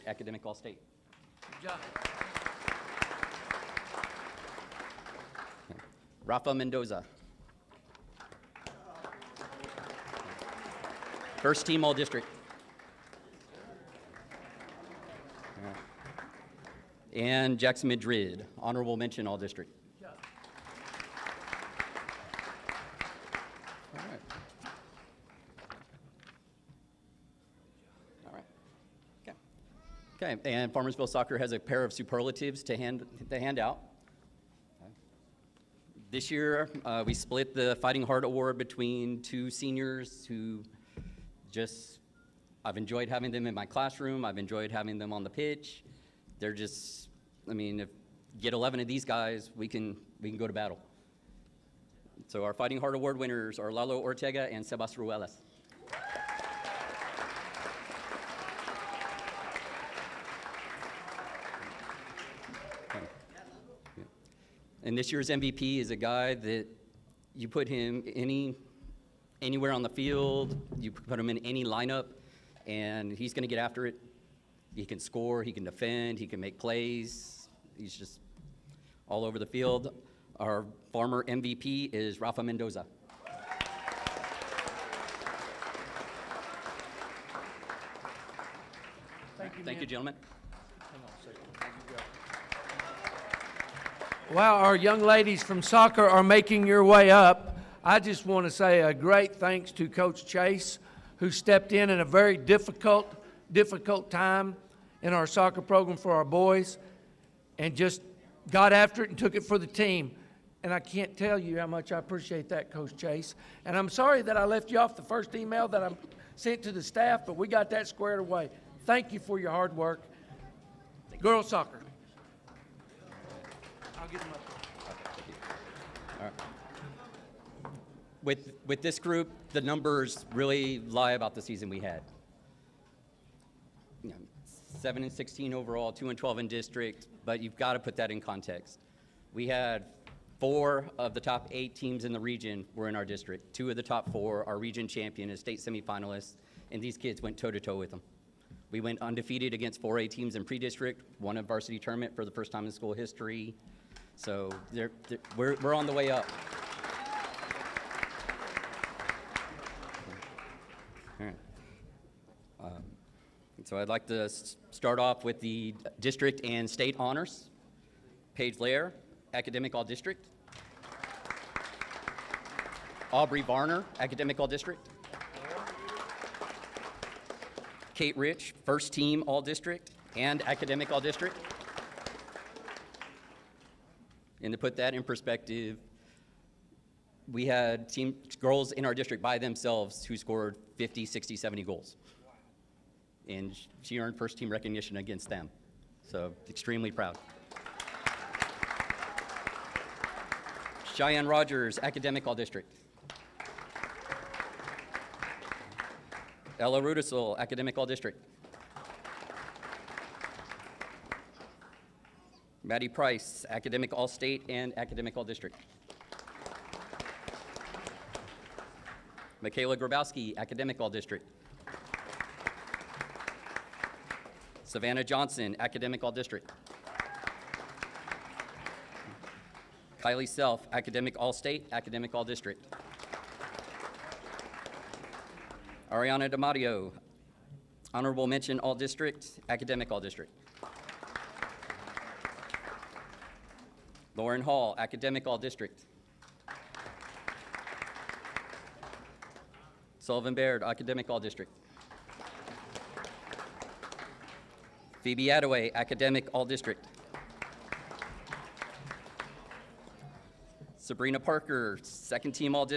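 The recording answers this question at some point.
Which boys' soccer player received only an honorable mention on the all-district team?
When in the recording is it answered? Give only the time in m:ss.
0:17.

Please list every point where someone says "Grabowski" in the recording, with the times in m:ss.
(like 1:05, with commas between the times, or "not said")
3:39.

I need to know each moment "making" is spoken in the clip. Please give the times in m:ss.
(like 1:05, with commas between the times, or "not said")
1:36.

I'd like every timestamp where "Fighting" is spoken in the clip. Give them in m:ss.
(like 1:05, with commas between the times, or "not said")
0:37, 0:52.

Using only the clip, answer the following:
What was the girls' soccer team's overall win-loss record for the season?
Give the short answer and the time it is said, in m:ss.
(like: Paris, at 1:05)
7 and 16, at 2:14.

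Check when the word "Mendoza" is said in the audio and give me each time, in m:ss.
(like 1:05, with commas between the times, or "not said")
0:06, 1:22.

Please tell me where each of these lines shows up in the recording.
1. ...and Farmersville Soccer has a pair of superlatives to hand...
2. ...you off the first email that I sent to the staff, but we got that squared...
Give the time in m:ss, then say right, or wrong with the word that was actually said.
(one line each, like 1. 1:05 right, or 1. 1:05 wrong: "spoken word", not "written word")
1. 0:30 right
2. 1:54 right.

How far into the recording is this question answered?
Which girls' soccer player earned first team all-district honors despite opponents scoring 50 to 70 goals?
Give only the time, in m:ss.
2:57.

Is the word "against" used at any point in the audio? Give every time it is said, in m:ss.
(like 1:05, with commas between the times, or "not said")
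2:29, 3:14.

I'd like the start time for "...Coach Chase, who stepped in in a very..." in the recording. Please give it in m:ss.
1:39.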